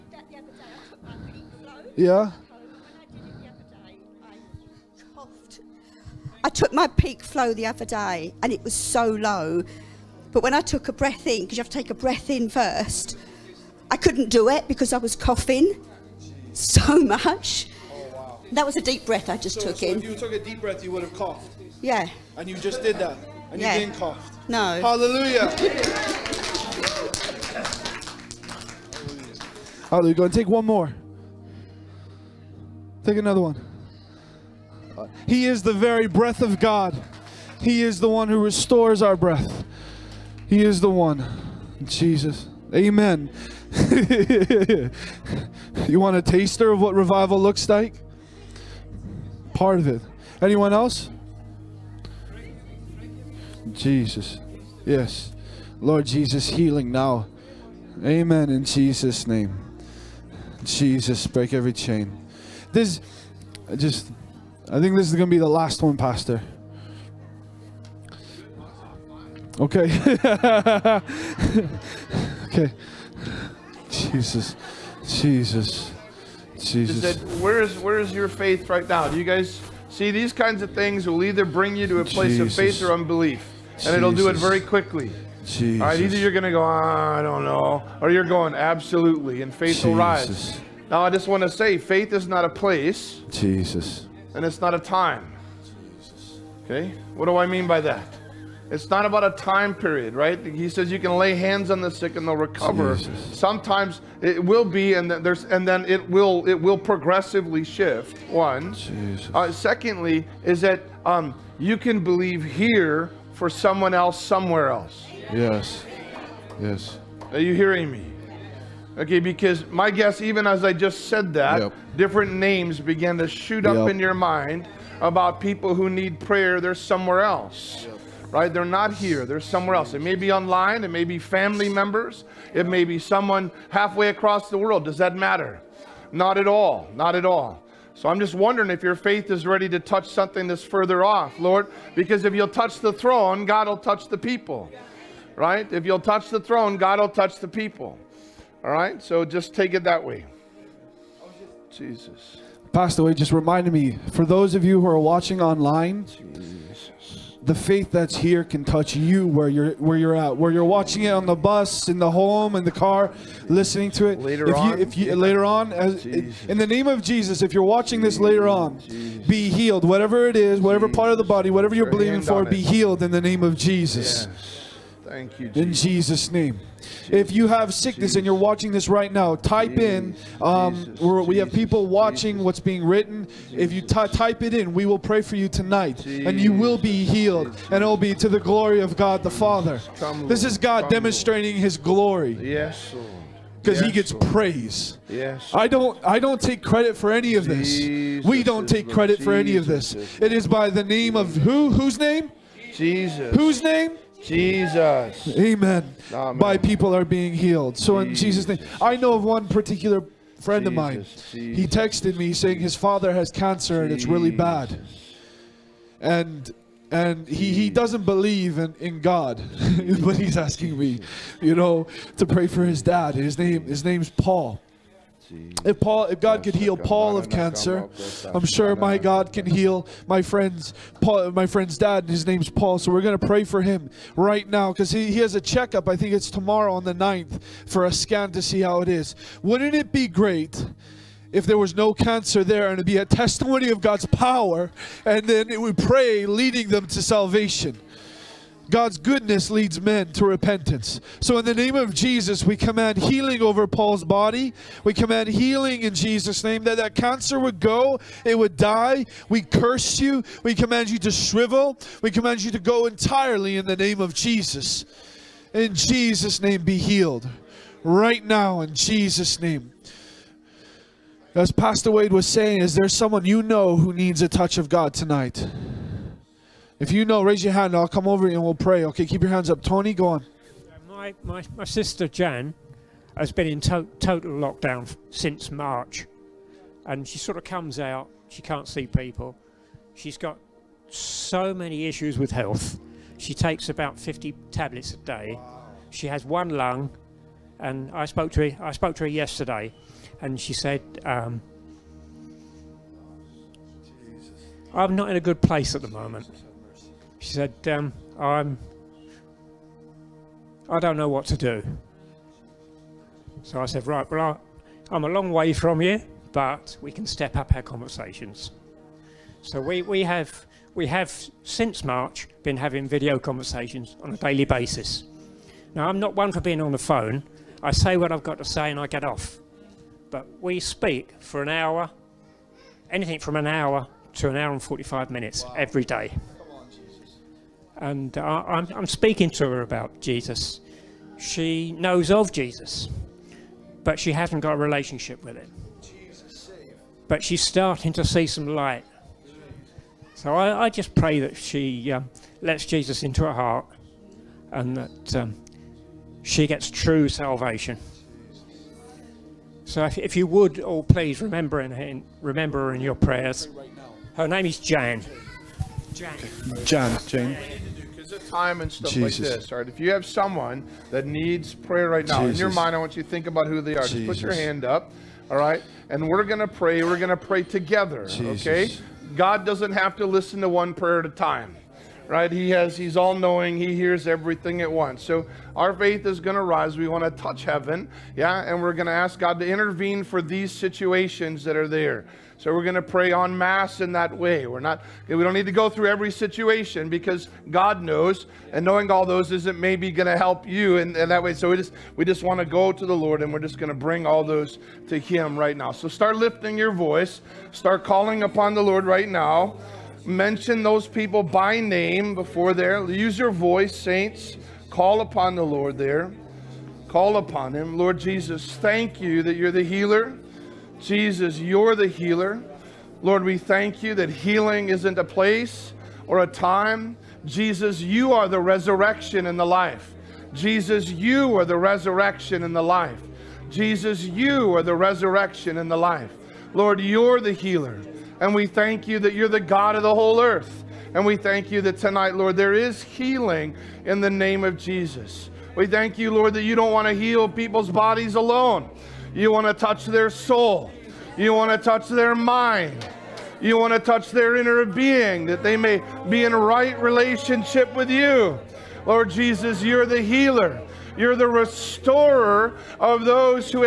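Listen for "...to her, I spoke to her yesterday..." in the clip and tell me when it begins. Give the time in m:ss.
4:58.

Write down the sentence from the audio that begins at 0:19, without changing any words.
If you took a deep breath, you would have coughed.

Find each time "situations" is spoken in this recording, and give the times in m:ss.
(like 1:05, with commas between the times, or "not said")
6:30, 6:36.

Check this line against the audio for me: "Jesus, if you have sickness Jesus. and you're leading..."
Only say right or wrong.
wrong.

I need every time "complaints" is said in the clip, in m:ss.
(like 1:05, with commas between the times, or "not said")
not said.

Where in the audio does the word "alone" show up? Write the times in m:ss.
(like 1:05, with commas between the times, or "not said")
7:28.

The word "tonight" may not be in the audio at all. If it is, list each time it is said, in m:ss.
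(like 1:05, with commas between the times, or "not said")
3:05, 4:34, 7:21.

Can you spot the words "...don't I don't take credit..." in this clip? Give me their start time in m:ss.
3:15.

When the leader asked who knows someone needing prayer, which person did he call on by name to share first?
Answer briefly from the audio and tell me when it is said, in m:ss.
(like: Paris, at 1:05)
Tony, at 4:39.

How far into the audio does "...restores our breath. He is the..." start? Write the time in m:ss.
0:38.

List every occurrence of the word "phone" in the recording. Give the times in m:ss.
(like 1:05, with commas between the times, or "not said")
5:26.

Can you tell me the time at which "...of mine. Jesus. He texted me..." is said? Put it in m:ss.
3:30.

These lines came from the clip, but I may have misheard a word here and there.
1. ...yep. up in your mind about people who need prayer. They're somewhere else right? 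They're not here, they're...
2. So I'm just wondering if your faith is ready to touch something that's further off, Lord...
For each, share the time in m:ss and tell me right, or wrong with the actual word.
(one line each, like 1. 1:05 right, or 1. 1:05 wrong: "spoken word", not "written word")
1. 2:03 right
2. 2:17 right.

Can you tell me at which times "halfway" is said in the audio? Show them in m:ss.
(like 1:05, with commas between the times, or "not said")
2:13.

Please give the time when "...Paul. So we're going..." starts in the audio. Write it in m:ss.
3:52.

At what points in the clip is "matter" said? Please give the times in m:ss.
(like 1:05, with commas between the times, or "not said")
2:15.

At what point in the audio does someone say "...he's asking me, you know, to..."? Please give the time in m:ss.
3:40.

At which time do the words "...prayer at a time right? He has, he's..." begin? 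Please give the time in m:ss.
6:20.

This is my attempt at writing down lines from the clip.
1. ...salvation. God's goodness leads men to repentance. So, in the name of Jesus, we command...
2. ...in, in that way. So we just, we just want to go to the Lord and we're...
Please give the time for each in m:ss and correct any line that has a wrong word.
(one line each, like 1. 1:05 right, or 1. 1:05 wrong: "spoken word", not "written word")
1. 4:07 right
2. 6:40 right.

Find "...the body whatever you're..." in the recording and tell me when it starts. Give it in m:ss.
2:51.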